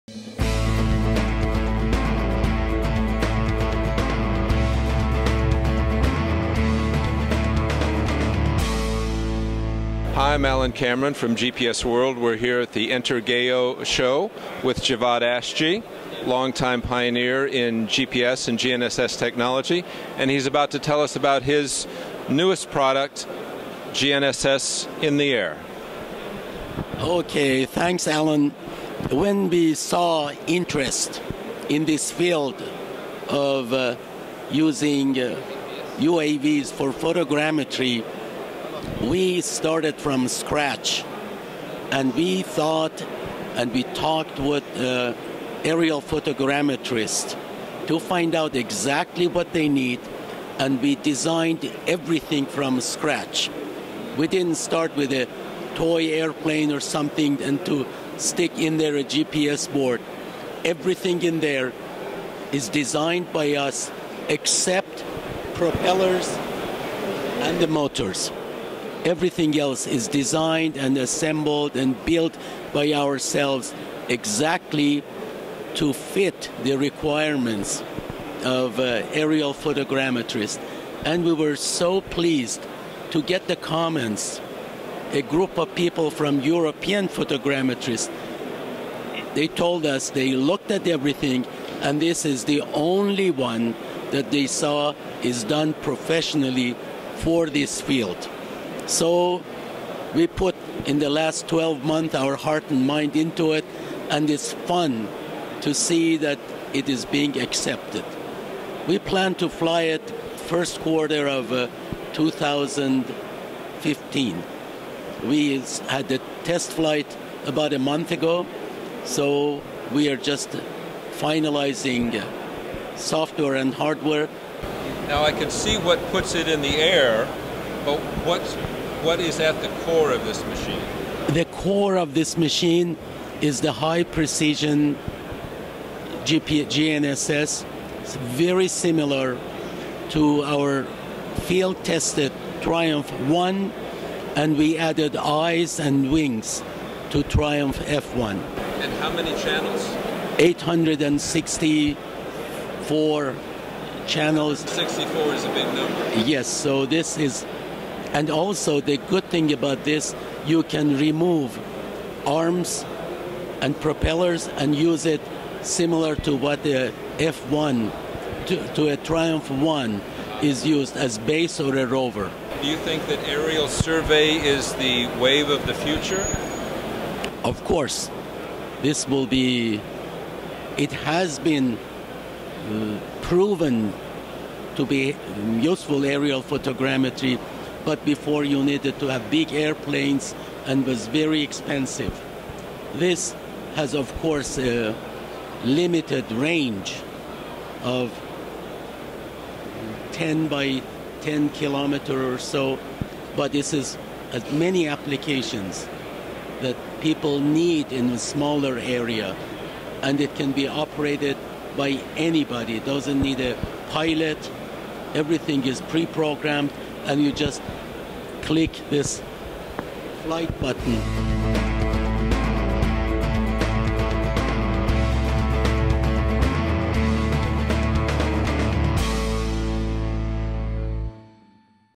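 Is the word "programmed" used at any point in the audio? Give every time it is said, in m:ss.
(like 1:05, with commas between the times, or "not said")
3:35.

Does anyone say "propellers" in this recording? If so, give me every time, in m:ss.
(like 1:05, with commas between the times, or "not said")
1:05, 2:43.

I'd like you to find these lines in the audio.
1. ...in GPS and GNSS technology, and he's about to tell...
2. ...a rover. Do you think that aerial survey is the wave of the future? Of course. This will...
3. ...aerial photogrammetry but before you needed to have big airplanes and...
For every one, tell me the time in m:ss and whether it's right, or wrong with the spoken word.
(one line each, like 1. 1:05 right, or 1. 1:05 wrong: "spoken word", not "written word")
1. 0:17 right
2. 2:51 right
3. 3:06 right.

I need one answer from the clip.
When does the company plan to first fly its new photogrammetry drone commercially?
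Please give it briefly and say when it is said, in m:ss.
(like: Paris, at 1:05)
First quarter of 2015, at 1:50.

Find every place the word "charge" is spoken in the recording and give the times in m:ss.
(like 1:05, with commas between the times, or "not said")
not said.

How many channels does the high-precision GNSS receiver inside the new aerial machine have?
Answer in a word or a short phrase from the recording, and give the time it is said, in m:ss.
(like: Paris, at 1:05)
864, at 2:30.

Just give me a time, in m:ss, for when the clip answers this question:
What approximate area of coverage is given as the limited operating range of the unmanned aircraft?
3:20.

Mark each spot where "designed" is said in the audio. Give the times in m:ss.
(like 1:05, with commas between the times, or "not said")
0:50, 1:02, 1:10.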